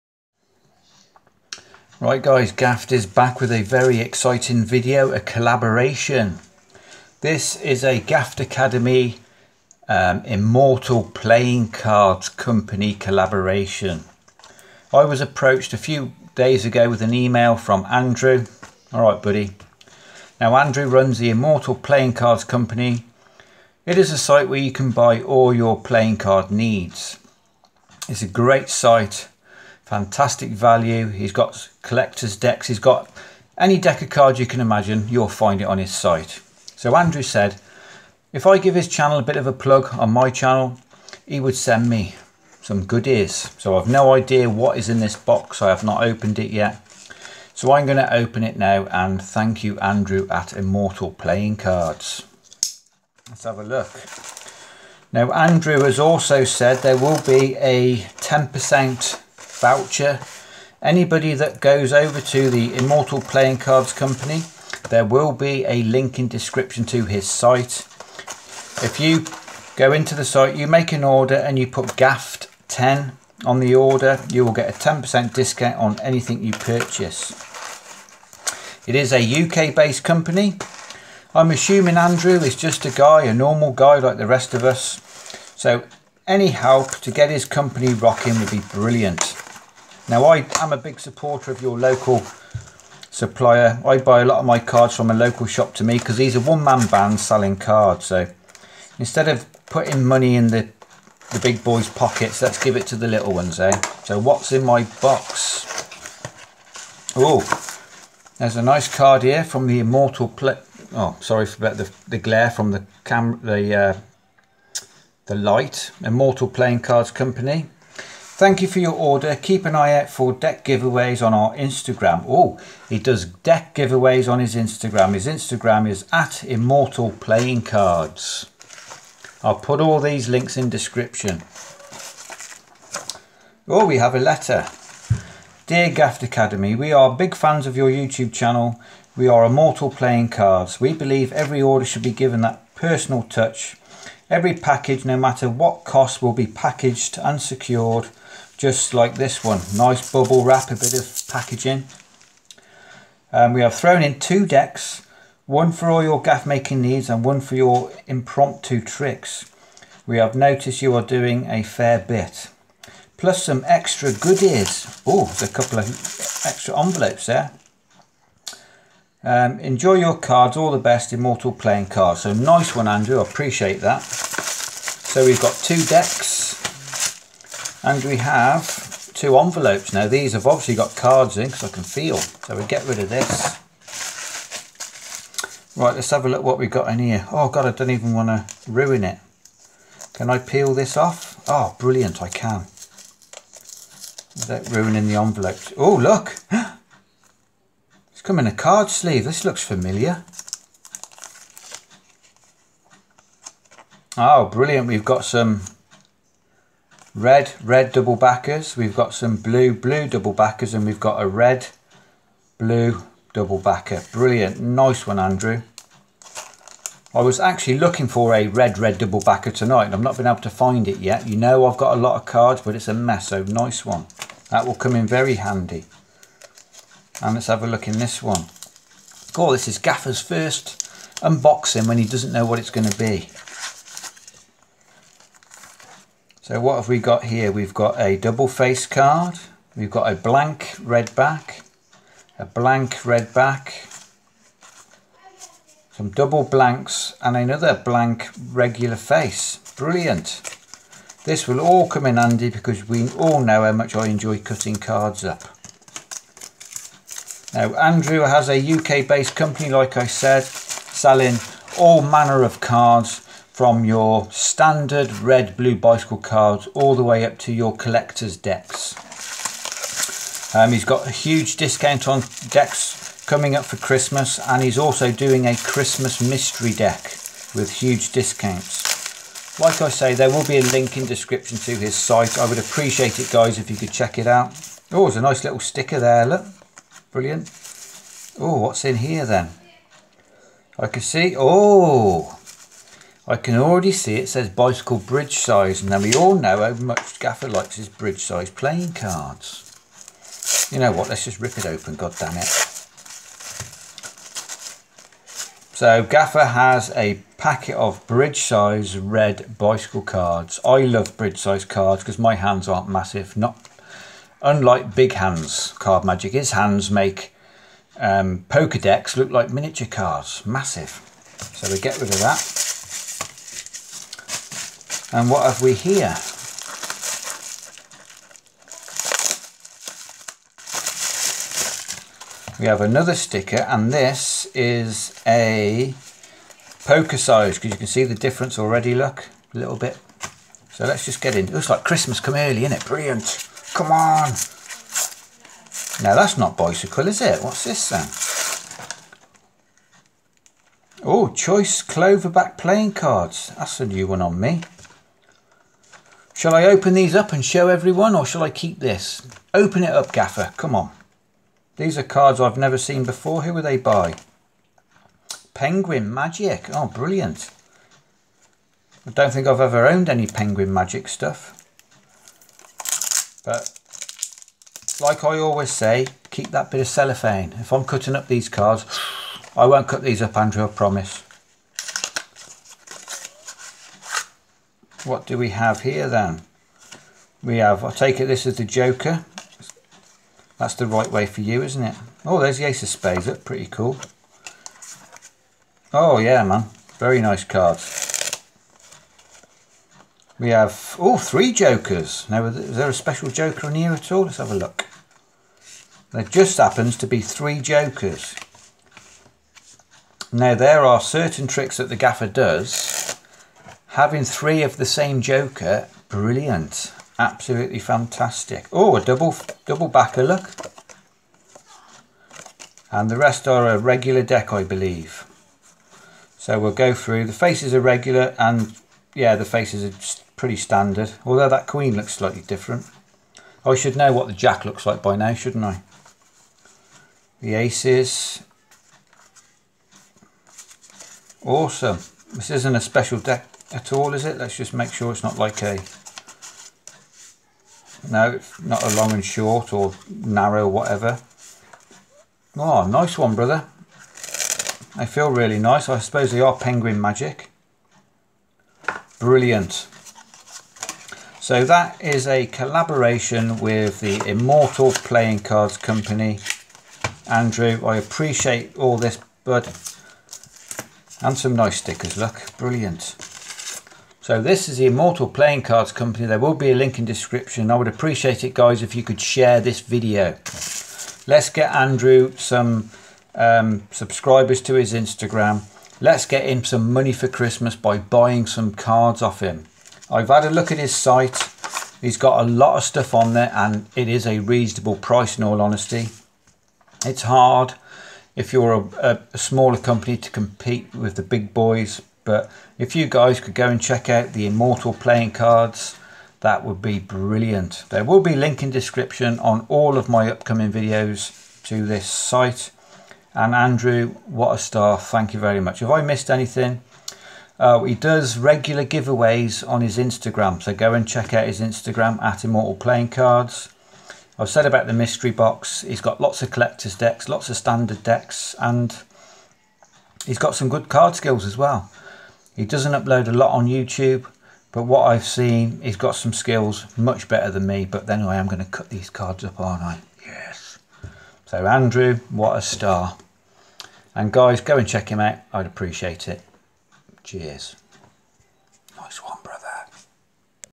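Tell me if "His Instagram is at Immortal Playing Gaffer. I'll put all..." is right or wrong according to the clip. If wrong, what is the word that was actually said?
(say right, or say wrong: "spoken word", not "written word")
wrong: "Cards", not "Gaffer".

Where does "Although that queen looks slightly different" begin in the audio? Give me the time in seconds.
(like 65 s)
431 s.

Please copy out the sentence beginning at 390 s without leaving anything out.
That's the right way for you, isn't it?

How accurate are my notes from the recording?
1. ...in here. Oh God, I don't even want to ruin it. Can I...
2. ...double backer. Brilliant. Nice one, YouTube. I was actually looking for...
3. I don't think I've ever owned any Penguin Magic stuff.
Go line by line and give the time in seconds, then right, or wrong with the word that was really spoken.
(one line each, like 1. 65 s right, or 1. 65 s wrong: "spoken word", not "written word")
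1. 186 s right
2. 213 s wrong: "Andrew", not "YouTube"
3. 369 s right.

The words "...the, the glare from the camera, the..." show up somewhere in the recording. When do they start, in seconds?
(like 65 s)
111 s.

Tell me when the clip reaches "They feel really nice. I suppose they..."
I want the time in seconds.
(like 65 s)
454 s.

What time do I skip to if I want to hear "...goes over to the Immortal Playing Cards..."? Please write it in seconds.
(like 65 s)
61 s.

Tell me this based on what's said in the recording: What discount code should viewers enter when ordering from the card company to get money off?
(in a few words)
GAFFED 10.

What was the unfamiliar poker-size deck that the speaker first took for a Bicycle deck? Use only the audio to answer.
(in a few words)
Choice Cloverback.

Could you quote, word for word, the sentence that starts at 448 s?
No, it's not a long and short or narrow, whatever.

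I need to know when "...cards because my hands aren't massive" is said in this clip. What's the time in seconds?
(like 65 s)
311 s.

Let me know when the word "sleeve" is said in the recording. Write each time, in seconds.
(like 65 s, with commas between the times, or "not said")
198 s.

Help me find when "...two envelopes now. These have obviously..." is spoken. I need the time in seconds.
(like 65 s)
179 s.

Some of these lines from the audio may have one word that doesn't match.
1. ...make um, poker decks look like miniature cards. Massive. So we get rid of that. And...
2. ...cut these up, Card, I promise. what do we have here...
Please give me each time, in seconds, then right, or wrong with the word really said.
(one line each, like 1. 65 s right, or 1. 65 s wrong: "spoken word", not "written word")
1. 316 s right
2. 379 s wrong: "Andrew", not "Card".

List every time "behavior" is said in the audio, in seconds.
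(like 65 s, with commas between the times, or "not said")
not said.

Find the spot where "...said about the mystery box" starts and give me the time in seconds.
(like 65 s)
524 s.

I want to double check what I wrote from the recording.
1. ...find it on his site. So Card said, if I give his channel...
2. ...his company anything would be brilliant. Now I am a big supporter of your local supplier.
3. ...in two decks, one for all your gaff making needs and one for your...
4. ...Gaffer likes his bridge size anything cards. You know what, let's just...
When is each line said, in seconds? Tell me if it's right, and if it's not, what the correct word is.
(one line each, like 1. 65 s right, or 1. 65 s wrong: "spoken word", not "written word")
1. 35 s wrong: "Andrew", not "Card"
2. 87 s wrong: "rocking", not "anything"
3. 154 s right
4. 297 s wrong: "playing", not "anything".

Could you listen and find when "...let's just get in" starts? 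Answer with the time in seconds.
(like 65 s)
340 s.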